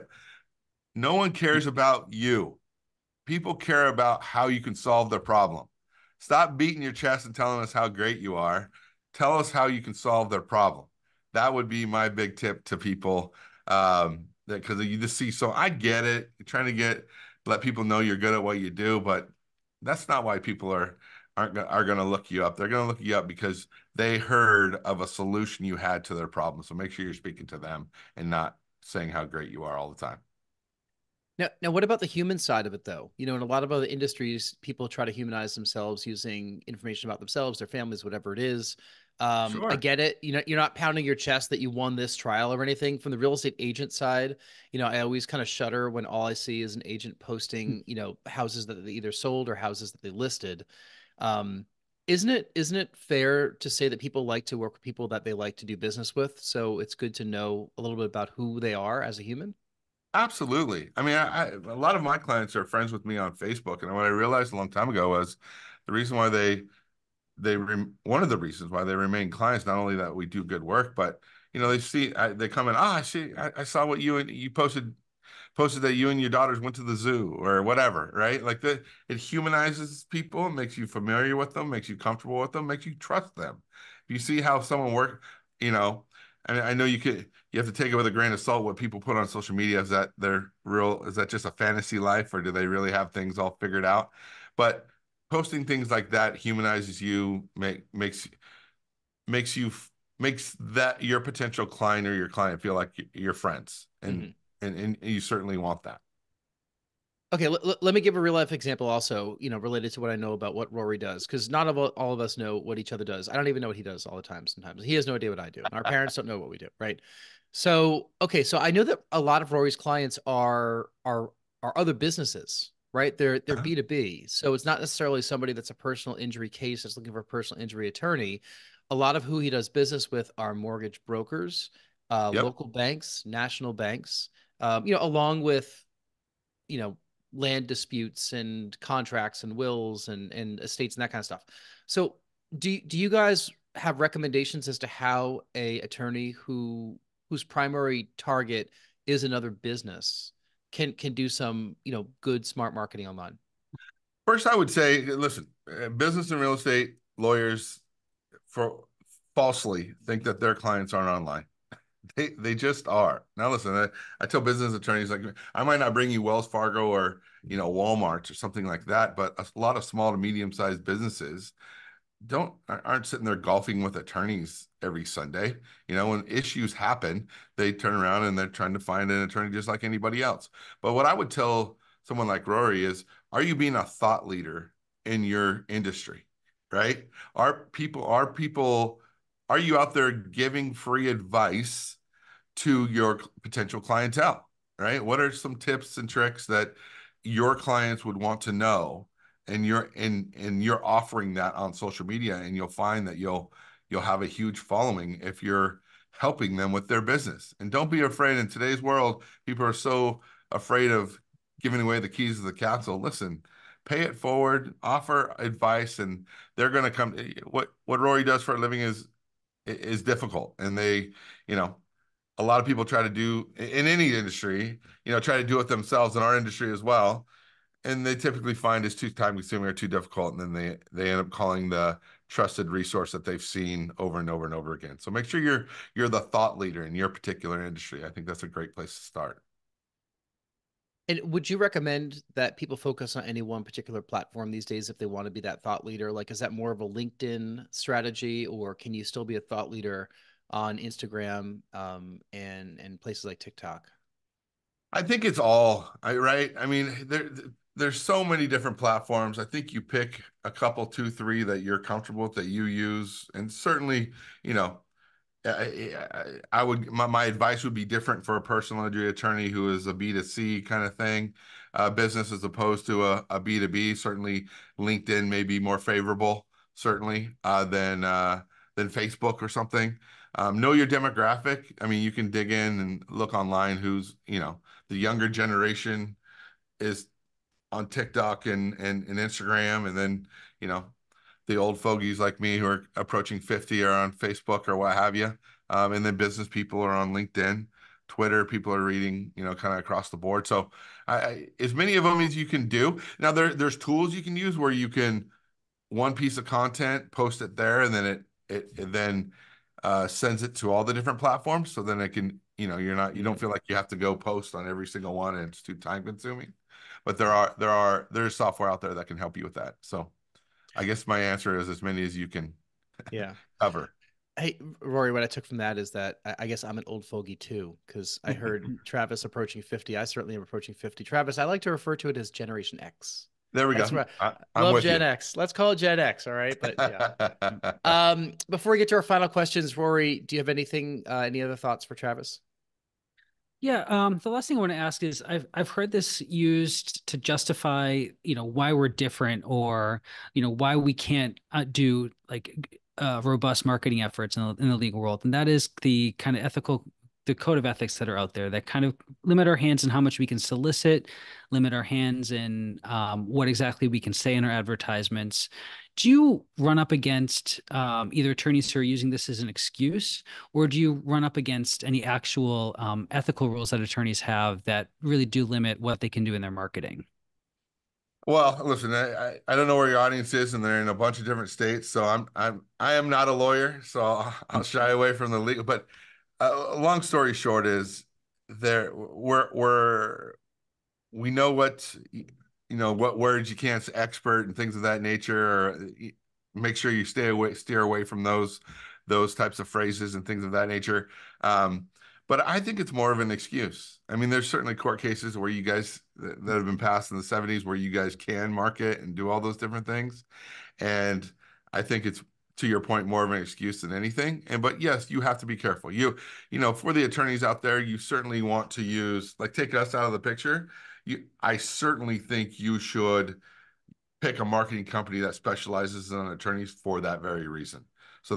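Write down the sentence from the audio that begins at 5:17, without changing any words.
But there are, there are, there's software out there that can help you with that.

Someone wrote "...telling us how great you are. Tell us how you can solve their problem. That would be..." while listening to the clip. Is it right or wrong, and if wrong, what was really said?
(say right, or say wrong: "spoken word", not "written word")
right.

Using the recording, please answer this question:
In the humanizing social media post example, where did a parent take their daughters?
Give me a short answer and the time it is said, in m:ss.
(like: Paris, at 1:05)
the zoo, at 1:16.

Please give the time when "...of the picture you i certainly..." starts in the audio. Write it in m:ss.
7:00.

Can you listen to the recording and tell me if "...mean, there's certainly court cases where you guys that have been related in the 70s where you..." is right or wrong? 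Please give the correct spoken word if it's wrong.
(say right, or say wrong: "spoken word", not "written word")
wrong: "passed", not "related".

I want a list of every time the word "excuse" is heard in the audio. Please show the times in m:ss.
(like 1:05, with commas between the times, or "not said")
6:09, 6:43, 6:53.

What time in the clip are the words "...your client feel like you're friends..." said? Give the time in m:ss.
1:42.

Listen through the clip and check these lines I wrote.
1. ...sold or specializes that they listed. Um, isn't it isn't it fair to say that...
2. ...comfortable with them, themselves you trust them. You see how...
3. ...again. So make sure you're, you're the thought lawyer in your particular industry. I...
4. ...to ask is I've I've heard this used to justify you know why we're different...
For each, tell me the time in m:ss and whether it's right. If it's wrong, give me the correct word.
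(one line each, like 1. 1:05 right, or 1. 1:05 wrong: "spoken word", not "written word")
1. 0:49 wrong: "houses", not "specializes"
2. 1:21 wrong: "makes", not "themselves"
3. 3:54 wrong: "leader", not "lawyer"
4. 5:44 right.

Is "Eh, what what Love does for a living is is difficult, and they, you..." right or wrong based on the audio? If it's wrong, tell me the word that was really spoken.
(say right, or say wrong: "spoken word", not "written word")
wrong: "Rory", not "Love".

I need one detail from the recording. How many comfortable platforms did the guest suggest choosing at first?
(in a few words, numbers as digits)
2 or 3.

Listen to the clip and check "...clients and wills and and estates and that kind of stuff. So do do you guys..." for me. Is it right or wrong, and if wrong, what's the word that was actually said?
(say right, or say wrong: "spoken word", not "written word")
wrong: "contracts", not "clients".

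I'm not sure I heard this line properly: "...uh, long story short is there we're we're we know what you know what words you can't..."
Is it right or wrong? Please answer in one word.
right.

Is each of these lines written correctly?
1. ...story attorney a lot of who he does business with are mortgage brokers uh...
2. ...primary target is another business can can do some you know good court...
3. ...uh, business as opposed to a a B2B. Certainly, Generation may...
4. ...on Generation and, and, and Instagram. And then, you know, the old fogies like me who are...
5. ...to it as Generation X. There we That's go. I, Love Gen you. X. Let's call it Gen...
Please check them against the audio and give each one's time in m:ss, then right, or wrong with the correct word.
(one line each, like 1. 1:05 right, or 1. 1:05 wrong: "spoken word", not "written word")
1. 2:07 wrong: "injury", not "story"
2. 2:27 wrong: "smart", not "court"
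3. 4:31 wrong: "LinkedIn", not "Generation"
4. 4:47 wrong: "TikTok", not "Generation"
5. 5:31 right.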